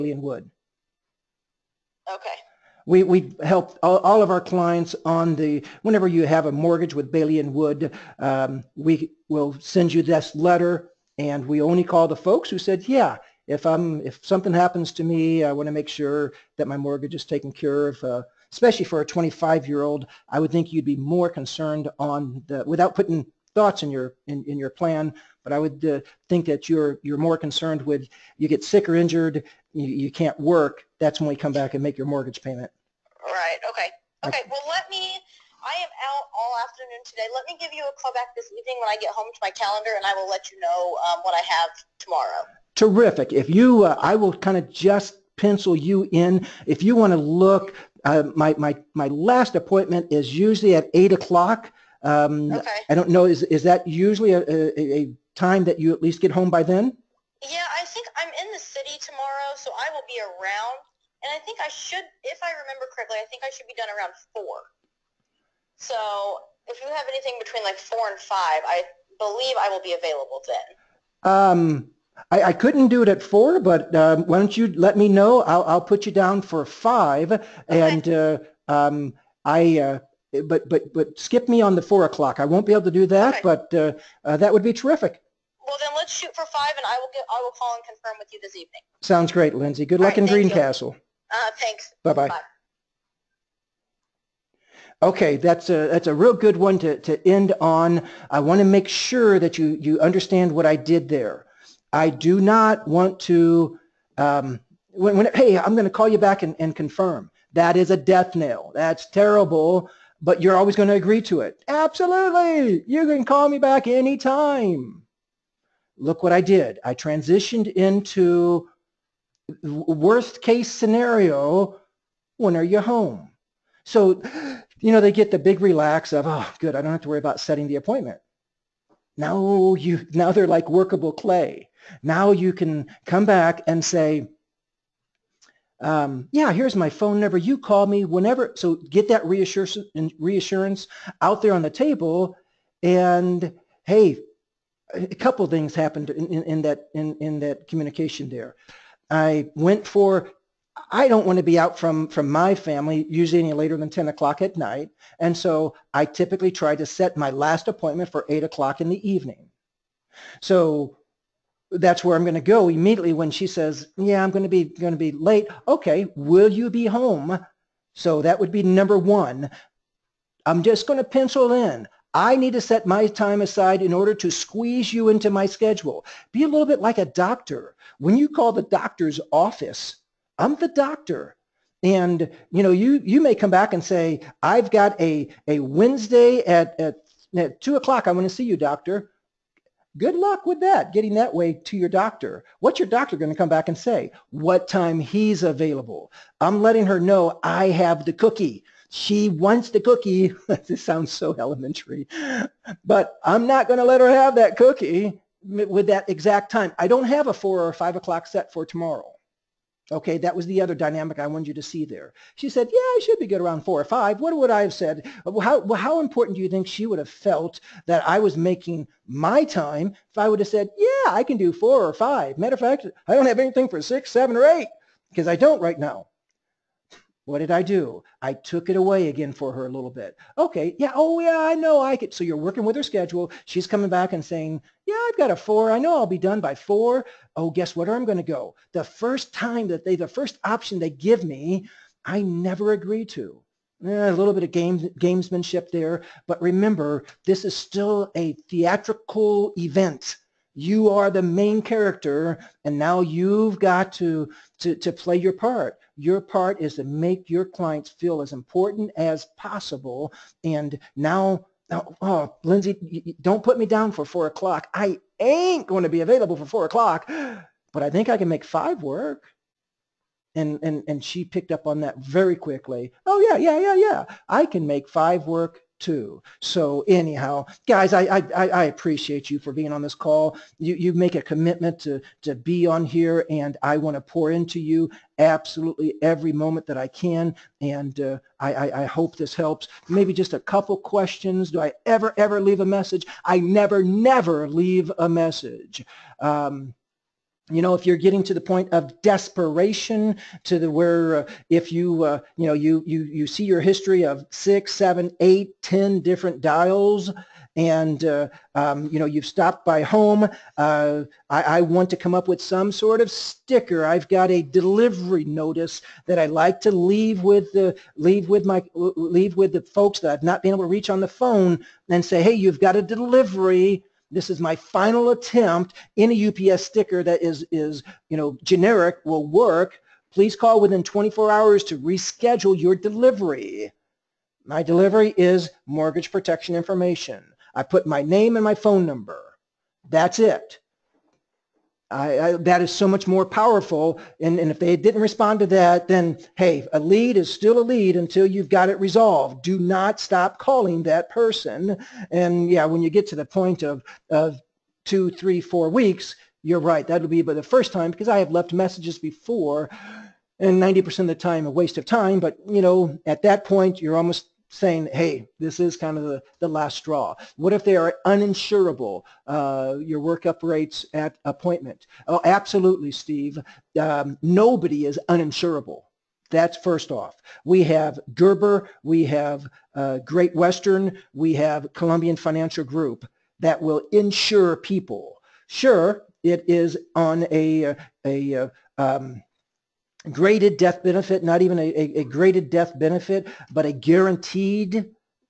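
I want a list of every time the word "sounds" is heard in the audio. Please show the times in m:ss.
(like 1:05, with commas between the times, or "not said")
1:29, 3:20.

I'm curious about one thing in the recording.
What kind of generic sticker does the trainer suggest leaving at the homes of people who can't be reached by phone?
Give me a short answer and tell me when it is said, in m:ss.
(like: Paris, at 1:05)
UPS sticker, at 5:26.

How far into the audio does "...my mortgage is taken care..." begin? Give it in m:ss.
0:16.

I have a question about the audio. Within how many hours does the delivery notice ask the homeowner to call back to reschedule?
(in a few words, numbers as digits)
24 hours.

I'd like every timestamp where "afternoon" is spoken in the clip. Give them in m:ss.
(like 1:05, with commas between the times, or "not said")
0:36.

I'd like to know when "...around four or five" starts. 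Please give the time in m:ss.
3:33.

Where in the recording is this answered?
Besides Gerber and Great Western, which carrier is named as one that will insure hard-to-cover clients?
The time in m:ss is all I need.
6:21.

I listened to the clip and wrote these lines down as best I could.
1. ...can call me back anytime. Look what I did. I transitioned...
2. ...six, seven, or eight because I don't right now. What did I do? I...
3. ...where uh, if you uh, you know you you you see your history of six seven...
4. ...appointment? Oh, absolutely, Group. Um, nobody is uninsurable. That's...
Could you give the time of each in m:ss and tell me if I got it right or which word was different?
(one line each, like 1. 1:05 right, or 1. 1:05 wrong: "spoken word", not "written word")
1. 1:53 right
2. 3:43 right
3. 5:00 right
4. 6:11 wrong: "Steve", not "Group".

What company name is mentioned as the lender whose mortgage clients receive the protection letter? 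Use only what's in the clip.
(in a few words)
Bailey and Wood.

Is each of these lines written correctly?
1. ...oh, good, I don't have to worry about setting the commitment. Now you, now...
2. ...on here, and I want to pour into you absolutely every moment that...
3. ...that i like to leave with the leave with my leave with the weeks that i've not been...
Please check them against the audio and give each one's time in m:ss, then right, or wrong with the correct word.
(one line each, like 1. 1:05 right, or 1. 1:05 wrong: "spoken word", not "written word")
1. 2:06 wrong: "appointment", not "commitment"
2. 4:42 right
3. 5:16 wrong: "folks", not "weeks".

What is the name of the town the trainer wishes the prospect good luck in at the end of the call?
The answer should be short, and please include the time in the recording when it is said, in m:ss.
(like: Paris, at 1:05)
Greencastle, at 1:30.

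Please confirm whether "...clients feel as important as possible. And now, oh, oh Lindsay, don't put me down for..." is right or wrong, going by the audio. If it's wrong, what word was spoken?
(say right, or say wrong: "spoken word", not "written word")
right.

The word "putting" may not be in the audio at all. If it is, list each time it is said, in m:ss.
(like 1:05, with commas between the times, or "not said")
0:22.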